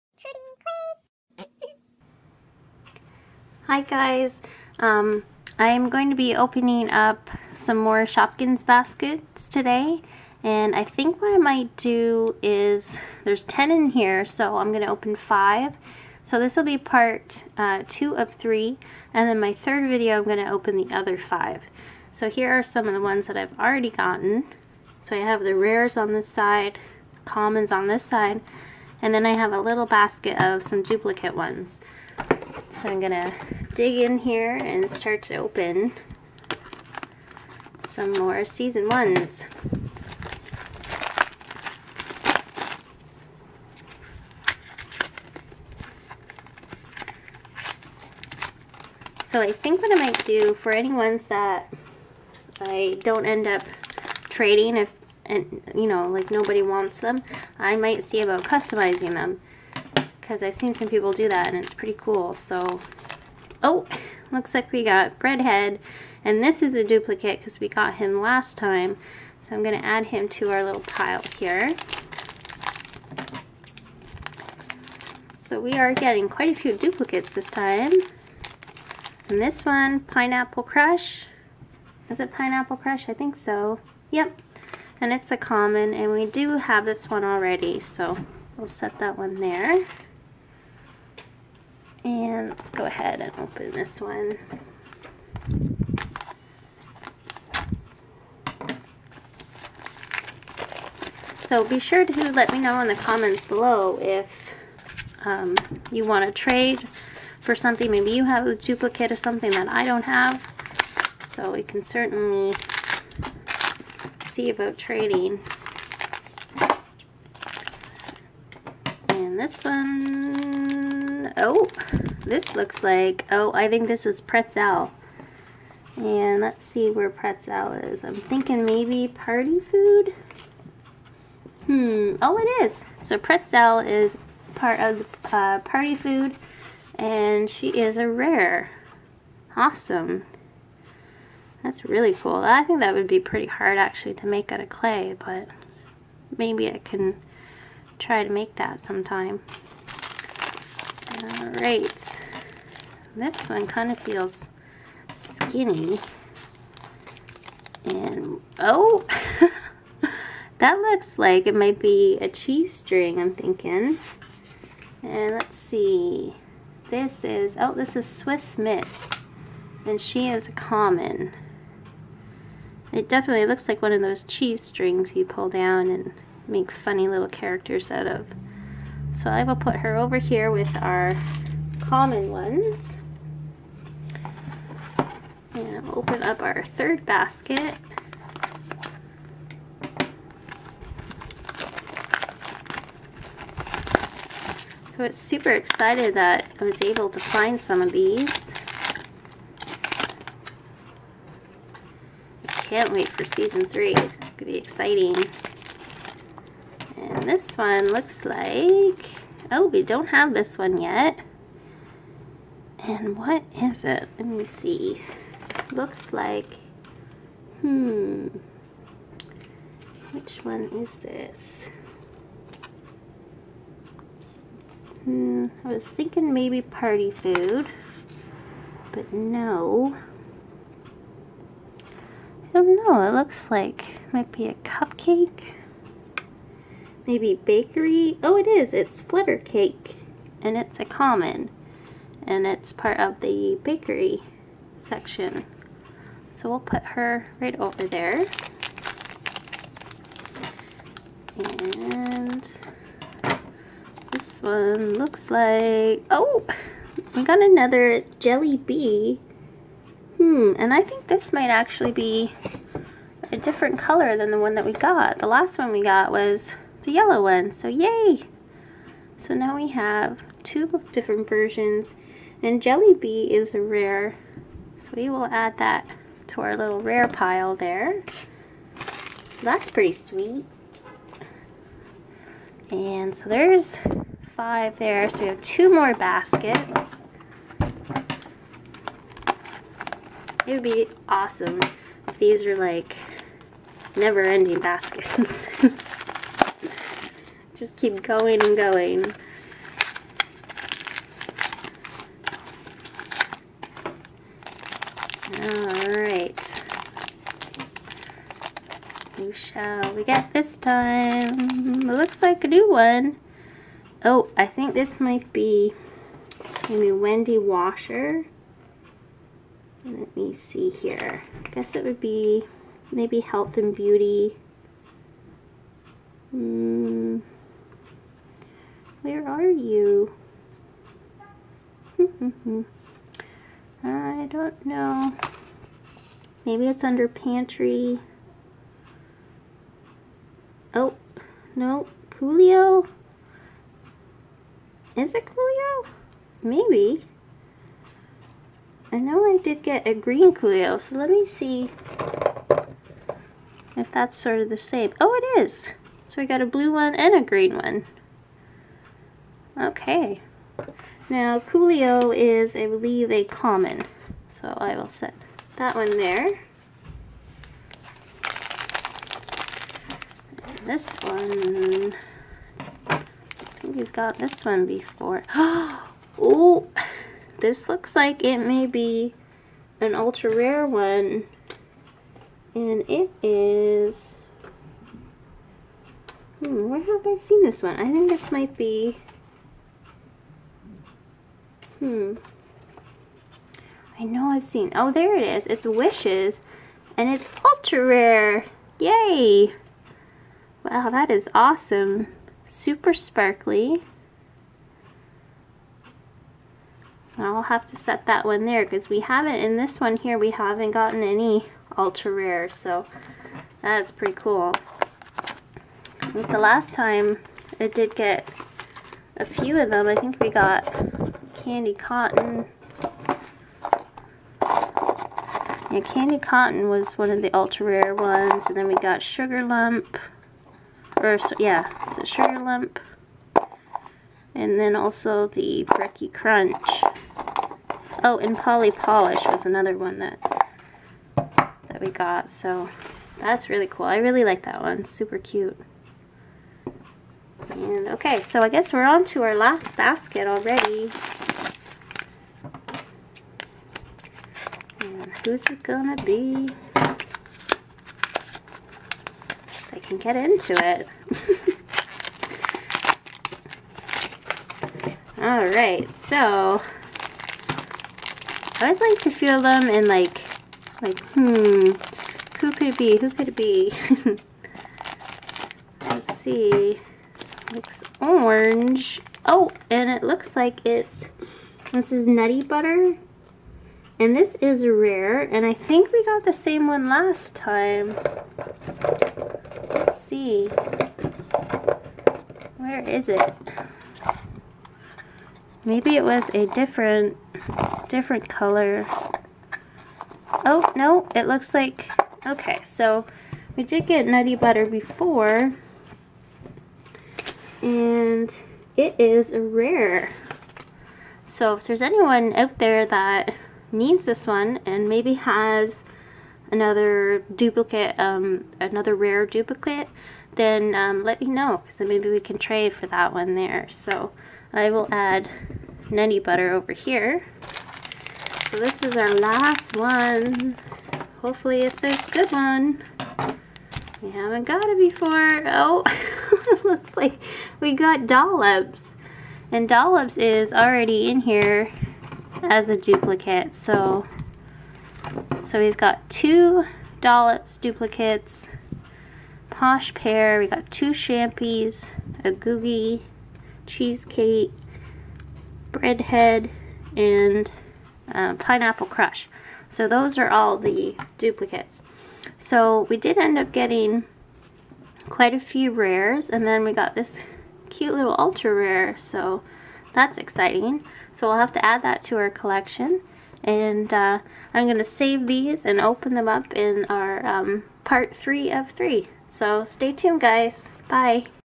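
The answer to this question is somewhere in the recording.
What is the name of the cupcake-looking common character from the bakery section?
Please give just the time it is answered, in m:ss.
3:59.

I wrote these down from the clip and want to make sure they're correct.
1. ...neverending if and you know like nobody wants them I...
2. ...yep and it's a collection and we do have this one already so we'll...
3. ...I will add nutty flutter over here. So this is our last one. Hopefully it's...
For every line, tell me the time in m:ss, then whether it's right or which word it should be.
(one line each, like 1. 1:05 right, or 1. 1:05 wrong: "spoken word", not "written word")
1. 0:54 wrong: "trading", not "neverending"
2. 1:24 wrong: "common", not "collection"
3. 8:44 wrong: "butter", not "flutter".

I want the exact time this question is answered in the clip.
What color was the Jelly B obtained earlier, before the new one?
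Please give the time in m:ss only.
4:26.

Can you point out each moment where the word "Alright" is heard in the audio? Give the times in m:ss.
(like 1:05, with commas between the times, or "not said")
2:31, 5:05.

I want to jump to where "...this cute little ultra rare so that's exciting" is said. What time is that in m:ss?
9:26.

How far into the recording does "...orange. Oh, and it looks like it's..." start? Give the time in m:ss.
7:58.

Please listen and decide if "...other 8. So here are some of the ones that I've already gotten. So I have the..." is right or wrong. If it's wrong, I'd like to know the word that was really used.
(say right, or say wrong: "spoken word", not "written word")
wrong: "5", not "8".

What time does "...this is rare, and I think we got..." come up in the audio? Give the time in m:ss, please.
8:04.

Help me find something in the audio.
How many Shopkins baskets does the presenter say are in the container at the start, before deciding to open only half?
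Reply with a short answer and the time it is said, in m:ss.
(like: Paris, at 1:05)
10, at 0:13.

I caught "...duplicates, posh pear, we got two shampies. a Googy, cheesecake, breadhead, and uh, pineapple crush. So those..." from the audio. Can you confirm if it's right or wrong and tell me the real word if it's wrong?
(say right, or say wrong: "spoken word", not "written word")
right.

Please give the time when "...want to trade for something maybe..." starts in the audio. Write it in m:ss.
1:46.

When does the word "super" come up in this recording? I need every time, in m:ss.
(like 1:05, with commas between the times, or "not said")
3:15, 6:42, 7:24.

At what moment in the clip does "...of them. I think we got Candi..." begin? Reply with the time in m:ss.
6:59.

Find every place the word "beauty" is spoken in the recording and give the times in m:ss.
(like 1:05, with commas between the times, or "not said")
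5:23.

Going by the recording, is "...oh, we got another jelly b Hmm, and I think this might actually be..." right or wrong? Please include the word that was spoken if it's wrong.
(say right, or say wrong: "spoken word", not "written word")
right.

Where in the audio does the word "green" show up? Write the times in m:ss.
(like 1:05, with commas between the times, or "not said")
5:49, 5:57.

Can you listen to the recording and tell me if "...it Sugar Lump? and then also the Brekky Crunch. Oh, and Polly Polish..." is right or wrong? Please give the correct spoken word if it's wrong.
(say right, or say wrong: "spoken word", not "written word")
right.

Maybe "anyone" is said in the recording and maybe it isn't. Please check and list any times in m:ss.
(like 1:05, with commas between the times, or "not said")
8:31.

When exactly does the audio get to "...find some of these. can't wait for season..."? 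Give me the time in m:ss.
3:17.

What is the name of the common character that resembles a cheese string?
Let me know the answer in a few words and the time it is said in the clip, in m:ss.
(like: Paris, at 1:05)
Swiss Miss, at 2:48.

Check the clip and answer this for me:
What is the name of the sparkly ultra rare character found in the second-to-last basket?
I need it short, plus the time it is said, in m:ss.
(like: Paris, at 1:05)
Wishes, at 6:35.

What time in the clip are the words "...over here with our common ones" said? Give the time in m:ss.
2:59.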